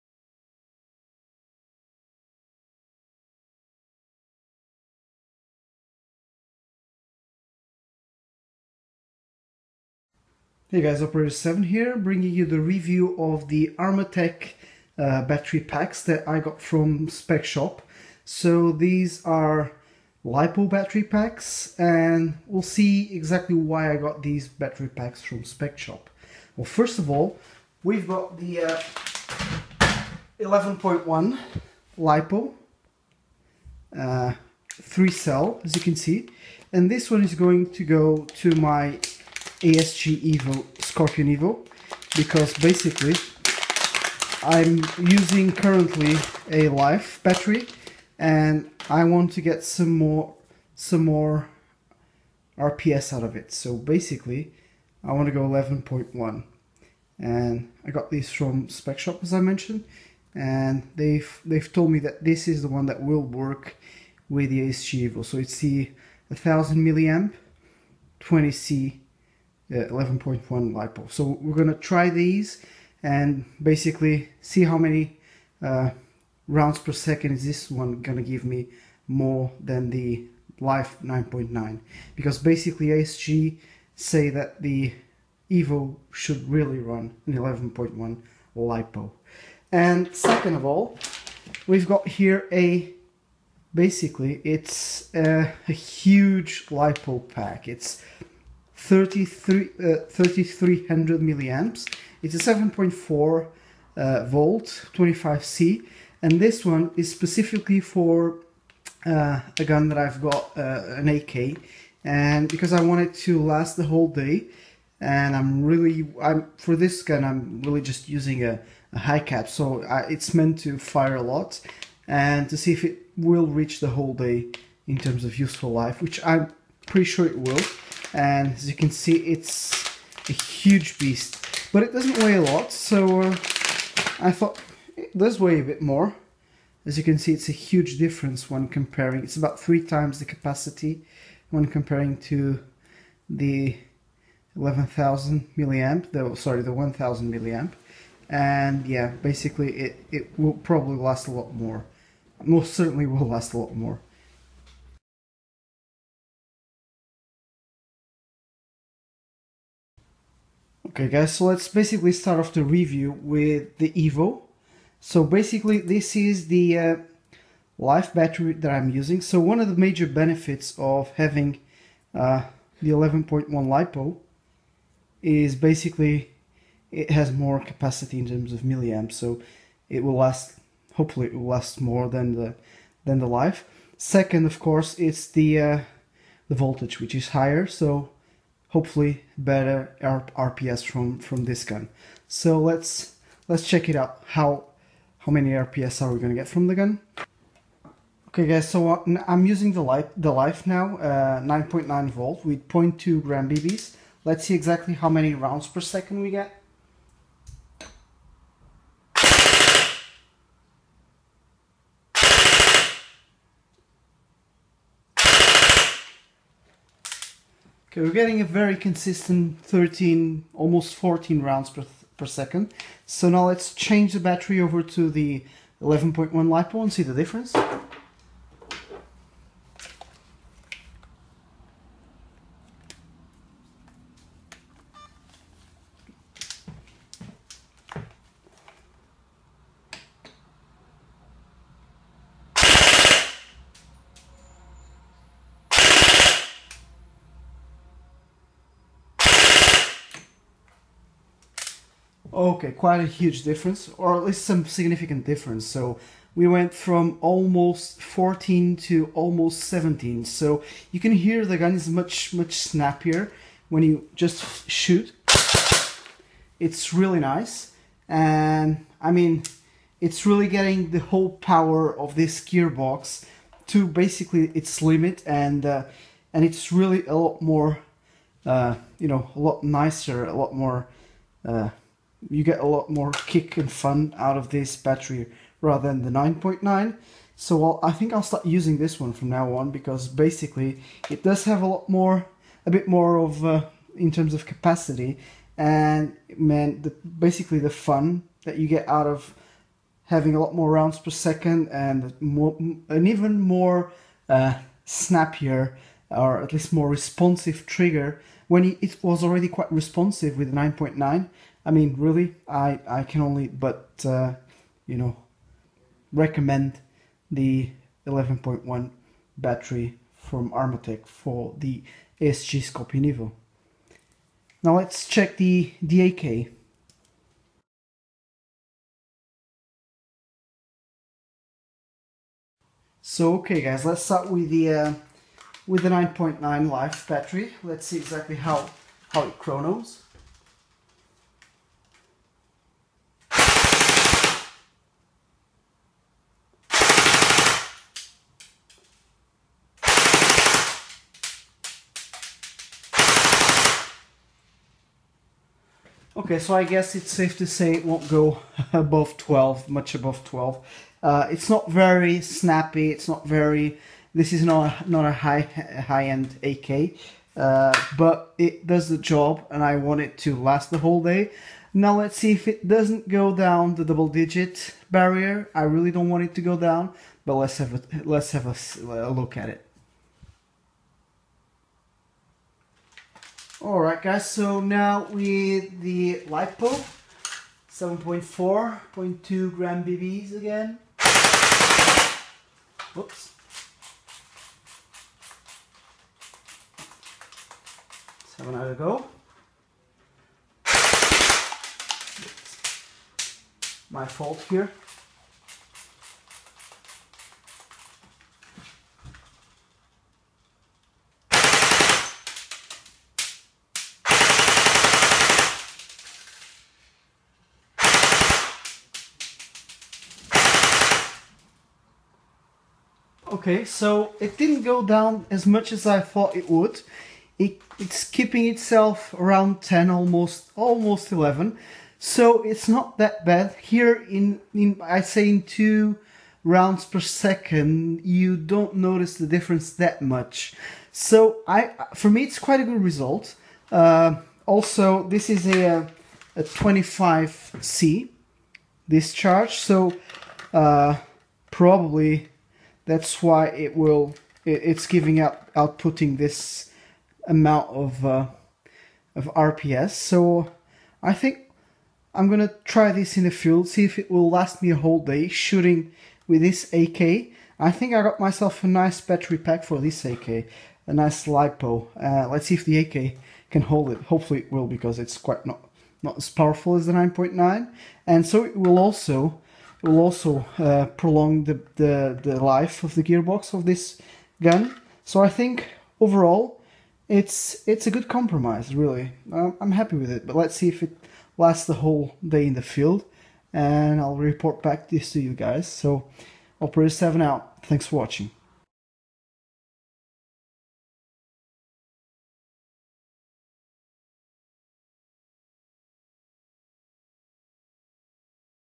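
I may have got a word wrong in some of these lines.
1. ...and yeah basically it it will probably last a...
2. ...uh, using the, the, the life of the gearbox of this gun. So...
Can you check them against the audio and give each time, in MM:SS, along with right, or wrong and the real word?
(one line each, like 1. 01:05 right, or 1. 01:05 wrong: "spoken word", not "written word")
1. 02:28 right
2. 08:00 wrong: "prolong", not "using".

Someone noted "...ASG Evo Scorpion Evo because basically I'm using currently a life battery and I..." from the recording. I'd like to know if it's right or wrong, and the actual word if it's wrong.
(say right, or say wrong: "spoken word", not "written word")
right.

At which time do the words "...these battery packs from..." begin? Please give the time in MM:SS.
00:24.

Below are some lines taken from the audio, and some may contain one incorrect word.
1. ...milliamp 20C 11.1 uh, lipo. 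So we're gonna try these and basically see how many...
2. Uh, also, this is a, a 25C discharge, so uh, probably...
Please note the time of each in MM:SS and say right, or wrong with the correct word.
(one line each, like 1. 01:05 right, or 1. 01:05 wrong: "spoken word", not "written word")
1. 01:06 right
2. 07:23 right.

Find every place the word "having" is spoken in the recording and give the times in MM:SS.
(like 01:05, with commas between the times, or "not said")
02:51, 05:00.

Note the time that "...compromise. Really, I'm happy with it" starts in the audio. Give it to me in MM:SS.
08:08.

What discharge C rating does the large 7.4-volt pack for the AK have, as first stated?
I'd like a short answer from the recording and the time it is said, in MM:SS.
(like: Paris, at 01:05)
25C, at 01:42.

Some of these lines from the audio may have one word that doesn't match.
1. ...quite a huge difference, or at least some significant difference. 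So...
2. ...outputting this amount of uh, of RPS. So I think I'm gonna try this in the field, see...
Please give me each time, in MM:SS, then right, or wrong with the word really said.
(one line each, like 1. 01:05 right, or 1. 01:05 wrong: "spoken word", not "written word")
1. 04:12 right
2. 07:35 right.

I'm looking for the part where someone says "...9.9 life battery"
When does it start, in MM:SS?
05:35.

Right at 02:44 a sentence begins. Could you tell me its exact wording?
So basically this is the uh, life battery that I'm using.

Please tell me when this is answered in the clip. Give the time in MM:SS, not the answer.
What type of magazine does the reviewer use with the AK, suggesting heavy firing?
01:58.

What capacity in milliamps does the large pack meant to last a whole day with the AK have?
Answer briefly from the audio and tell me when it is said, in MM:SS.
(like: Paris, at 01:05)
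3300, at 01:40.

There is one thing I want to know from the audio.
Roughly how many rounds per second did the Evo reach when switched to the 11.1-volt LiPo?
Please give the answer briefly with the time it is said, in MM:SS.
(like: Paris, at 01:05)
almost 17, at 04:19.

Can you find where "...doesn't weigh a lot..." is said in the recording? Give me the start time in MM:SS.
02:11.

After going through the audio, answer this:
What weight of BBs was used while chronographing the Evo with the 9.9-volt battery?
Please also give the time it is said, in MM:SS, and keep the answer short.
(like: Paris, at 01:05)
0.2 gram, at 03:22.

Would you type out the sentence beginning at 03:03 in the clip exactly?
Second, of course, it's the, uh, the voltage, which is higher, so hopefully better RPS from from this gun.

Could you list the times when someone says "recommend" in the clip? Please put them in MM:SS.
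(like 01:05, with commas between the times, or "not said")
05:16.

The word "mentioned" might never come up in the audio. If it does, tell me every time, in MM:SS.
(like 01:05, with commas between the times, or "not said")
00:59.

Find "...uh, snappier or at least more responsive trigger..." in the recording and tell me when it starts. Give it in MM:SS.
05:04.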